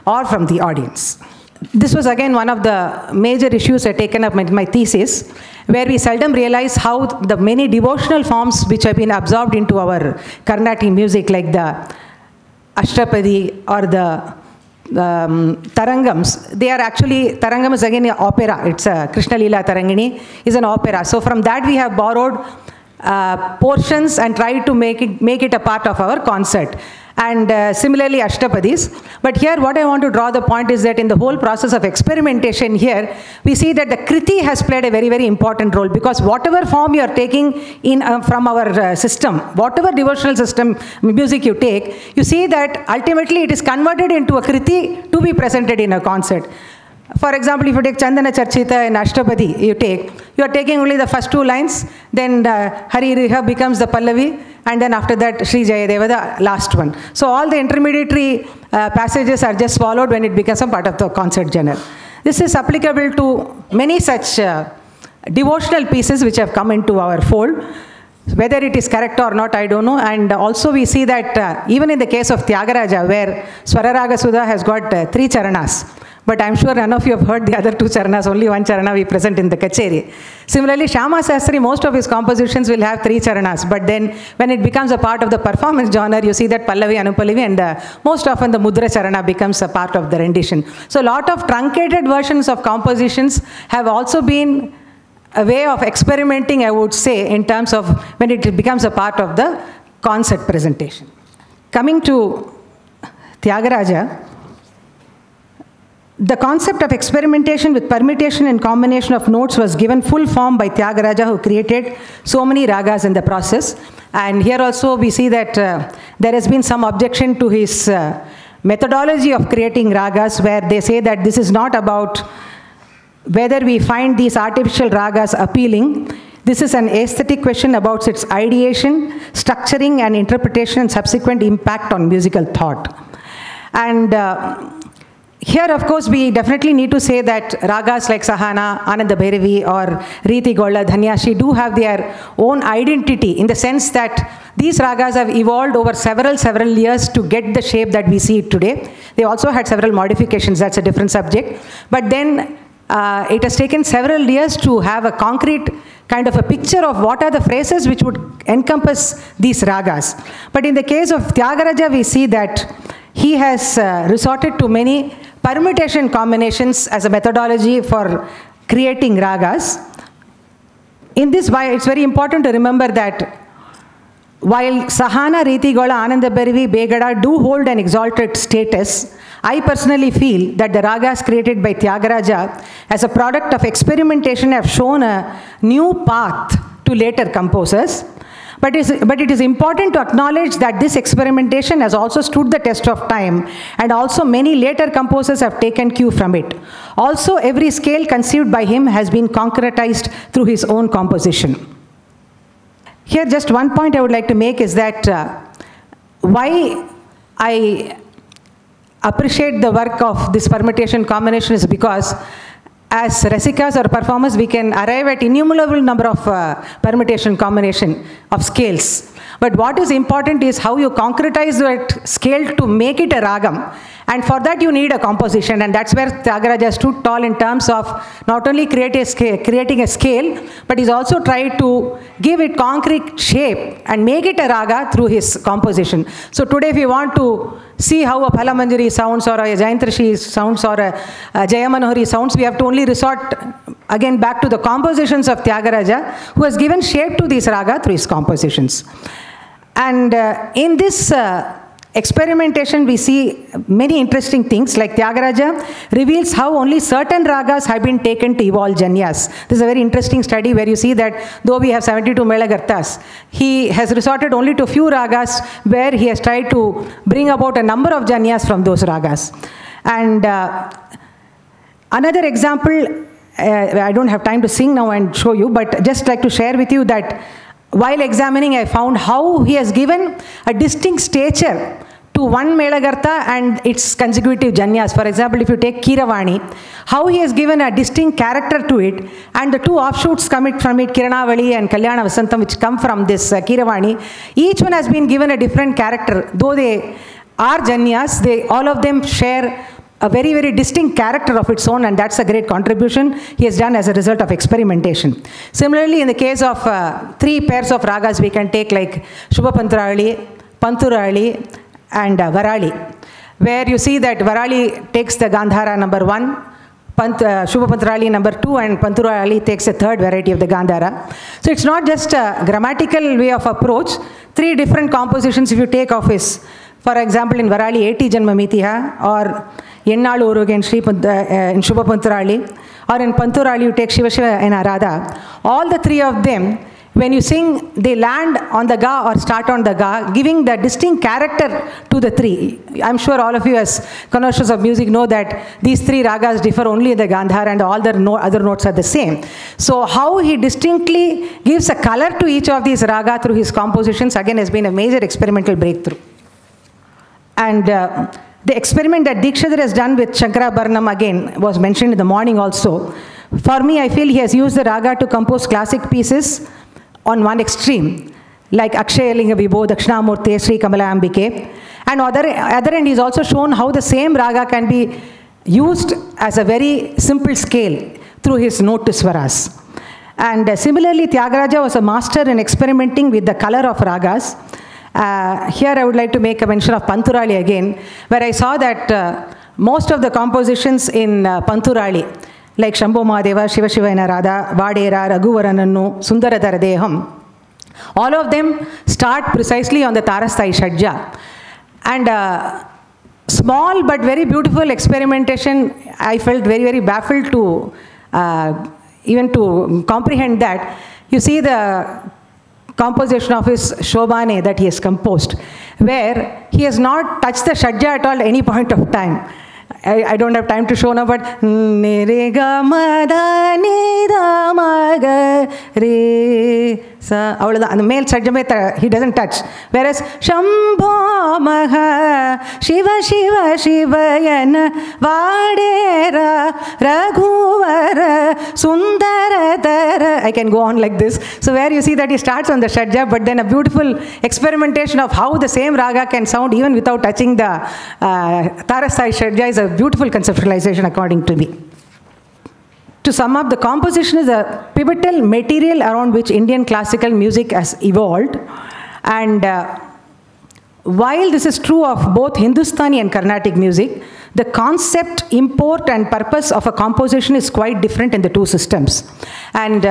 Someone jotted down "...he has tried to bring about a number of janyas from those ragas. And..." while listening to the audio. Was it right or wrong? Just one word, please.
right.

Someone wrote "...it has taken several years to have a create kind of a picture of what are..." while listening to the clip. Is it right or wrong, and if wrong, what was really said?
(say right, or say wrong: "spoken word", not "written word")
wrong: "concrete", not "create".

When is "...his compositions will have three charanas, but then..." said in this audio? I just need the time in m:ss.
1:21.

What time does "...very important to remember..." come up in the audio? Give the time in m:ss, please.
2:51.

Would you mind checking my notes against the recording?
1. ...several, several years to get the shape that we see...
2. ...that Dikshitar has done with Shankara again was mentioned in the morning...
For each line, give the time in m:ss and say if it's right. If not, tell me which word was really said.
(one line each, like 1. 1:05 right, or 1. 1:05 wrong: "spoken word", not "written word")
1. 2:25 right
2. 5:59 right.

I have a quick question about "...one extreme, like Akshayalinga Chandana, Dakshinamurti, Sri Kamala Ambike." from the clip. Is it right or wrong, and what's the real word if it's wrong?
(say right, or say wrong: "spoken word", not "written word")
wrong: "Vibho", not "Chandana".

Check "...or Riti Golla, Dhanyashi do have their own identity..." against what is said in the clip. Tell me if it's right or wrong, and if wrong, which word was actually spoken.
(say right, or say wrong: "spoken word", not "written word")
right.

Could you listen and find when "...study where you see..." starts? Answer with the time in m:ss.
4:20.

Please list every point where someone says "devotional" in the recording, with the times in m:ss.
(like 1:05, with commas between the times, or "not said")
0:07, 0:39, 1:05.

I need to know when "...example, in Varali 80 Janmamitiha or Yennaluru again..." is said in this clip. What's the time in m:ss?
5:26.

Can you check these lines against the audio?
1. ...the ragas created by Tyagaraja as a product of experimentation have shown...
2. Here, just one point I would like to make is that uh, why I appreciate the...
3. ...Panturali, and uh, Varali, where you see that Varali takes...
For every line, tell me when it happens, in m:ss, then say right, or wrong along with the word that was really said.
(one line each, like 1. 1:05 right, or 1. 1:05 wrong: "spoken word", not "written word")
1. 3:00 right
2. 3:23 right
3. 5:10 right.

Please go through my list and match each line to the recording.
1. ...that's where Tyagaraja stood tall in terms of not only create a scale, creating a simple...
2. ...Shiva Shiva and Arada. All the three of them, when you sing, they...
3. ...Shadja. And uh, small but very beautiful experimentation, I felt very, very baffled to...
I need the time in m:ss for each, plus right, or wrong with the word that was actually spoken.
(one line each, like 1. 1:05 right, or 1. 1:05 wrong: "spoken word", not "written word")
1. 3:45 wrong: "scale", not "simple"
2. 5:33 right
3. 6:40 right.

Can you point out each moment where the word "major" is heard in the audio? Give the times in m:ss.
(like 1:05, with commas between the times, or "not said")
0:03, 5:54.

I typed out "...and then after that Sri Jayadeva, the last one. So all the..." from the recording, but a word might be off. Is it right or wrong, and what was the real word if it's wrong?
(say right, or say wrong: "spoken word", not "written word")
right.